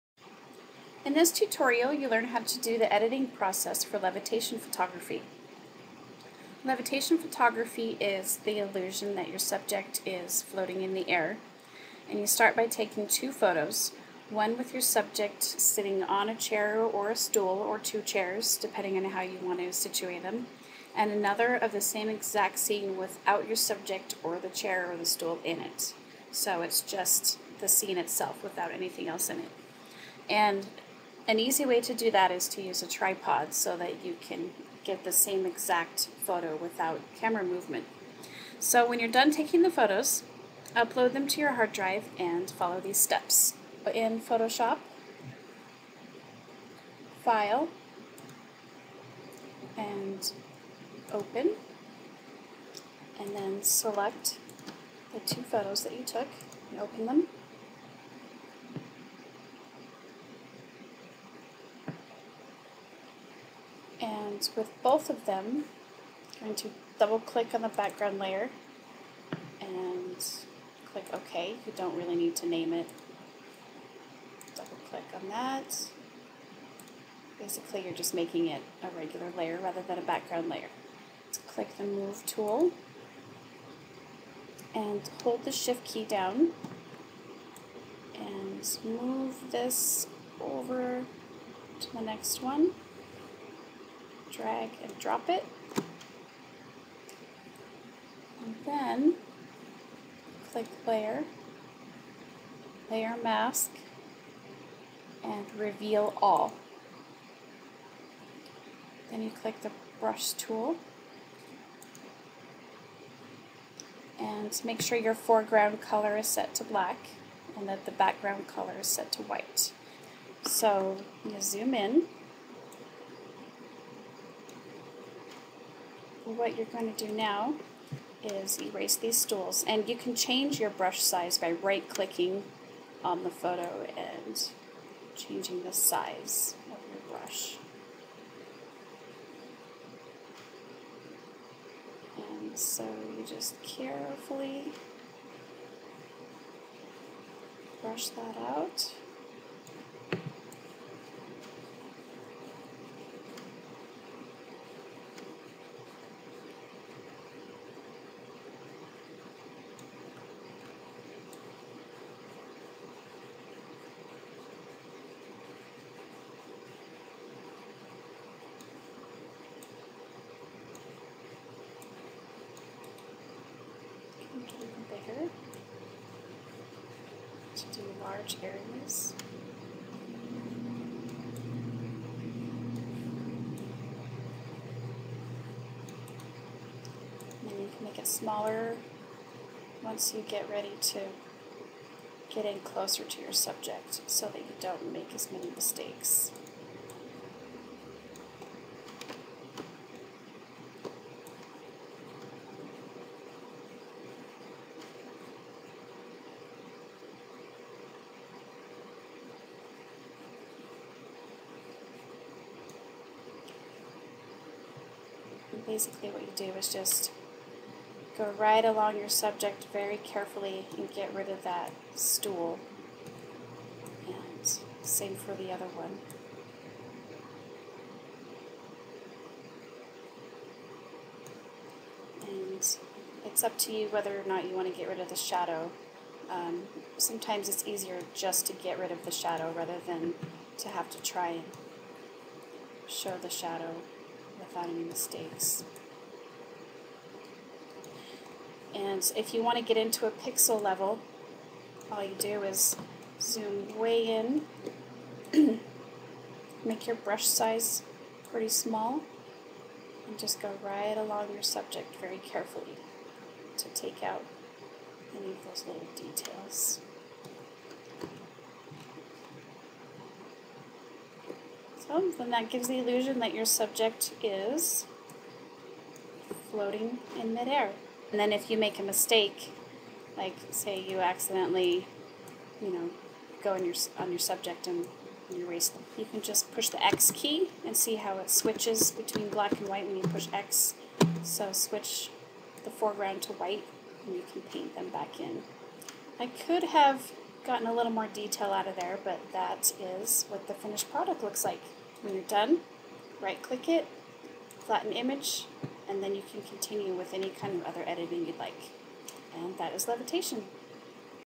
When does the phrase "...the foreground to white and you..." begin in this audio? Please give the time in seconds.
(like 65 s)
292 s.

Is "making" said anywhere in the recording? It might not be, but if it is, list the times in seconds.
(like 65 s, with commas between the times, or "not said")
78 s.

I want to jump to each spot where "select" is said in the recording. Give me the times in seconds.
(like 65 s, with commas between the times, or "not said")
53 s.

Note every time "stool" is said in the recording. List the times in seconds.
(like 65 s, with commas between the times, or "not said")
17 s, 25 s, 129 s, 221 s.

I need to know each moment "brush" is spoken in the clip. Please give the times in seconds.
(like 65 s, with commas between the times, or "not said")
109 s, 130 s, 137 s, 147 s, 256 s.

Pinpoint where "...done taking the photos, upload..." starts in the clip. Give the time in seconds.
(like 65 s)
39 s.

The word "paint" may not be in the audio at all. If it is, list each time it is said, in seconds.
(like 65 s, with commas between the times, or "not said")
294 s.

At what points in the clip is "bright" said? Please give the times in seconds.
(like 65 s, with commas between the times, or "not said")
not said.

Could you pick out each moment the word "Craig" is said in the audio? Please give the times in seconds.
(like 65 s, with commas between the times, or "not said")
not said.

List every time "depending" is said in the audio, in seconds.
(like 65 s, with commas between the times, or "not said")
18 s.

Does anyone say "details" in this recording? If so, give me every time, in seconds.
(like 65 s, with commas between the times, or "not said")
265 s, 298 s.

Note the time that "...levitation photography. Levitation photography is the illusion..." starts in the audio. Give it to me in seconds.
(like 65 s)
3 s.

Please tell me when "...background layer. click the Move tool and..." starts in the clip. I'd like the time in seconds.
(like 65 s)
80 s.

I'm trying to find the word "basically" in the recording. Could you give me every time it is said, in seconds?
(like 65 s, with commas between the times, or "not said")
77 s, 215 s.